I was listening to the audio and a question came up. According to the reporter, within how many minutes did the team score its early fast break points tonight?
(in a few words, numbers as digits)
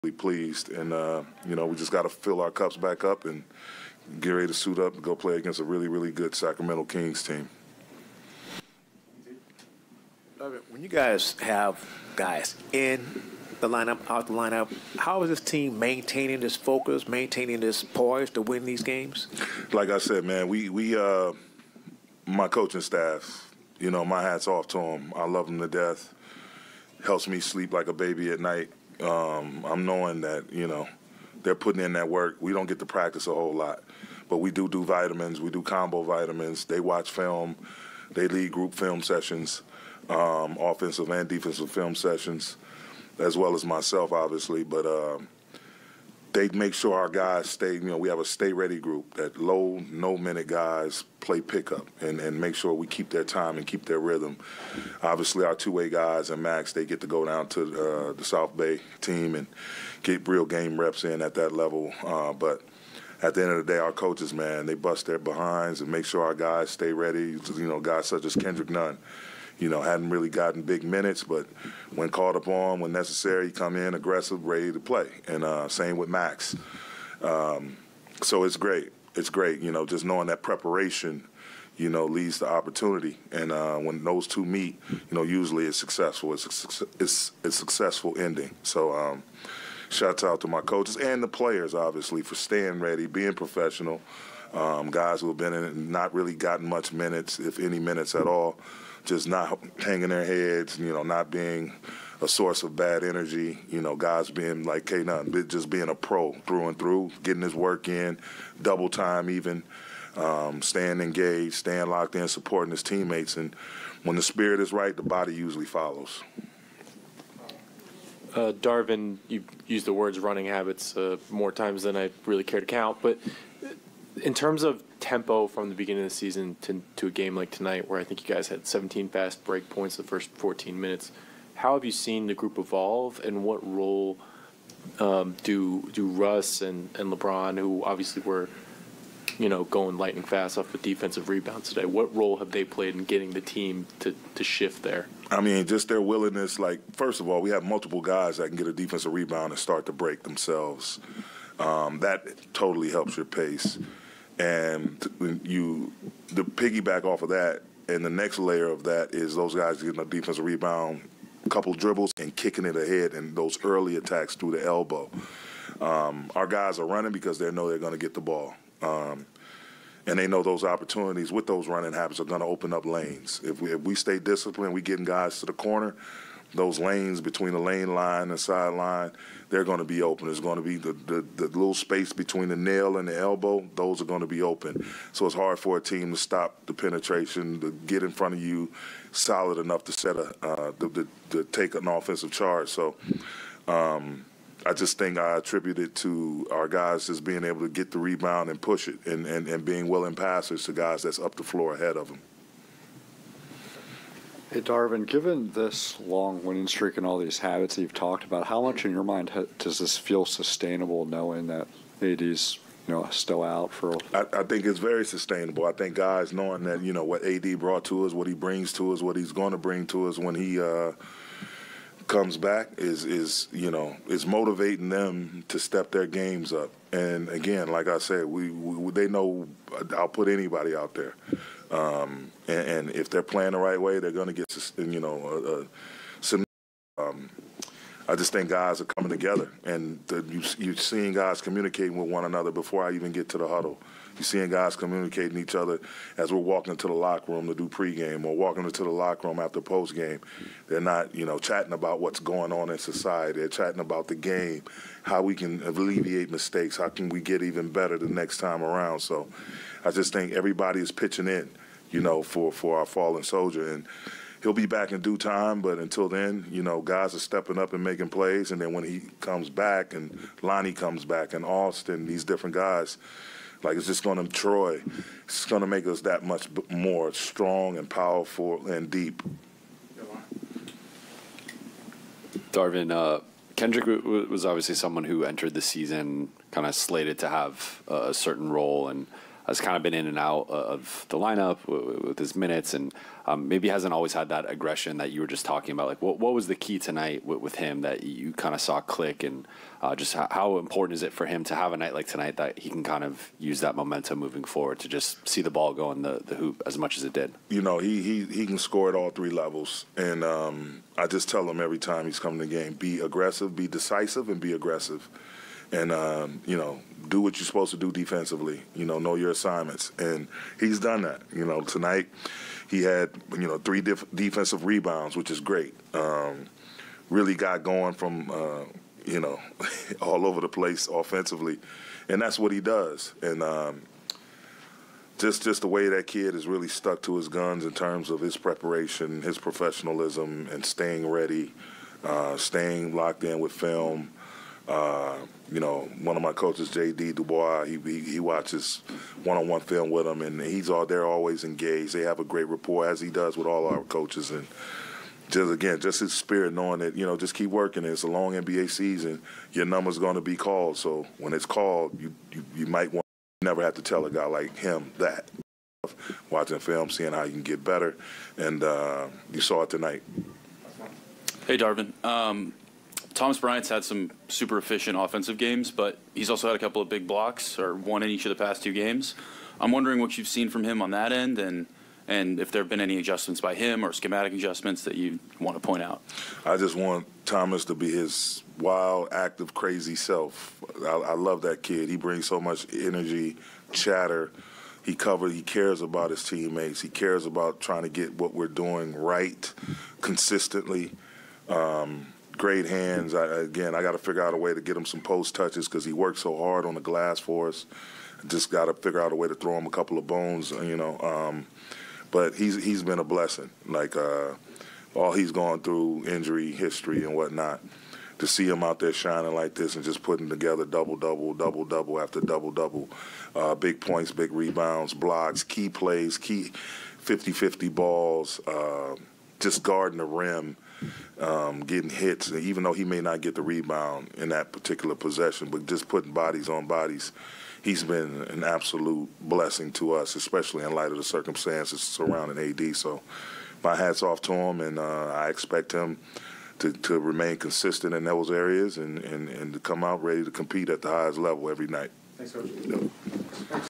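14.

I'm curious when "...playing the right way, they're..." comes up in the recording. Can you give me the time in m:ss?
3:53.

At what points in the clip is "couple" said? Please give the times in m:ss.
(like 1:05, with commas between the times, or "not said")
2:41, 6:16, 6:49.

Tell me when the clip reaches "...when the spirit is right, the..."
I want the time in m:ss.
1:54.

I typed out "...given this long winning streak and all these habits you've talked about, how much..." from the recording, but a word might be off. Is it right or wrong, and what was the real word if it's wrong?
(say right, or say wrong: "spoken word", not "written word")
right.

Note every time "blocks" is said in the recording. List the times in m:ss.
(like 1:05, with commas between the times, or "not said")
6:17, 7:04.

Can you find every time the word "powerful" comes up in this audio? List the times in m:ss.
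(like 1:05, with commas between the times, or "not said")
4:37.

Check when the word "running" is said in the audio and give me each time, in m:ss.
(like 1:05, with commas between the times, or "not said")
2:00, 2:46, 2:51.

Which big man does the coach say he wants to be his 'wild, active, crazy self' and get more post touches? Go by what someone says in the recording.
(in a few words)
Thomas Bryant.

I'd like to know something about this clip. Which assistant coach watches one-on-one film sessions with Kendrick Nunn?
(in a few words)
J.D. Dubois.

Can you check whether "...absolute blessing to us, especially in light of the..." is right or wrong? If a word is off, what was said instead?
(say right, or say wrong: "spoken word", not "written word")
right.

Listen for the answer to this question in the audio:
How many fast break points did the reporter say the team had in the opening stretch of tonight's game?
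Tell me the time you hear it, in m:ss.
2:08.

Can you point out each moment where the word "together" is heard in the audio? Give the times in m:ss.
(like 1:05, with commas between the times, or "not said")
3:59, 7:00.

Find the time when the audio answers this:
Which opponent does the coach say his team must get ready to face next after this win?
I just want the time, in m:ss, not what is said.
0:06.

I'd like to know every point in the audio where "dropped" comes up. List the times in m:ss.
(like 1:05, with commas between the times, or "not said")
not said.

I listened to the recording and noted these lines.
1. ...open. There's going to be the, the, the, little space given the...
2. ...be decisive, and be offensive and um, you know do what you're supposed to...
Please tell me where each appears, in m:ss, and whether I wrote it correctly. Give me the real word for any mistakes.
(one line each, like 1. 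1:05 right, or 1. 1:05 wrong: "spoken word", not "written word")
1. 3:00 wrong: "between", not "given"
2. 5:13 wrong: "aggressive", not "offensive".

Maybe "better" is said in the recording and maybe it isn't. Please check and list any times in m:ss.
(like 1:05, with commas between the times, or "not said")
4:17, 6:07.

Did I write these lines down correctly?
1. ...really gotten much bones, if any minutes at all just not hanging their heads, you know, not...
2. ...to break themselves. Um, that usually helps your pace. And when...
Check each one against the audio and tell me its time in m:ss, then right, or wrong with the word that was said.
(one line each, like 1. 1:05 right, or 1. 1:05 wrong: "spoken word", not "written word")
1. 1:36 wrong: "minutes", not "bones"
2. 2:29 wrong: "totally", not "usually".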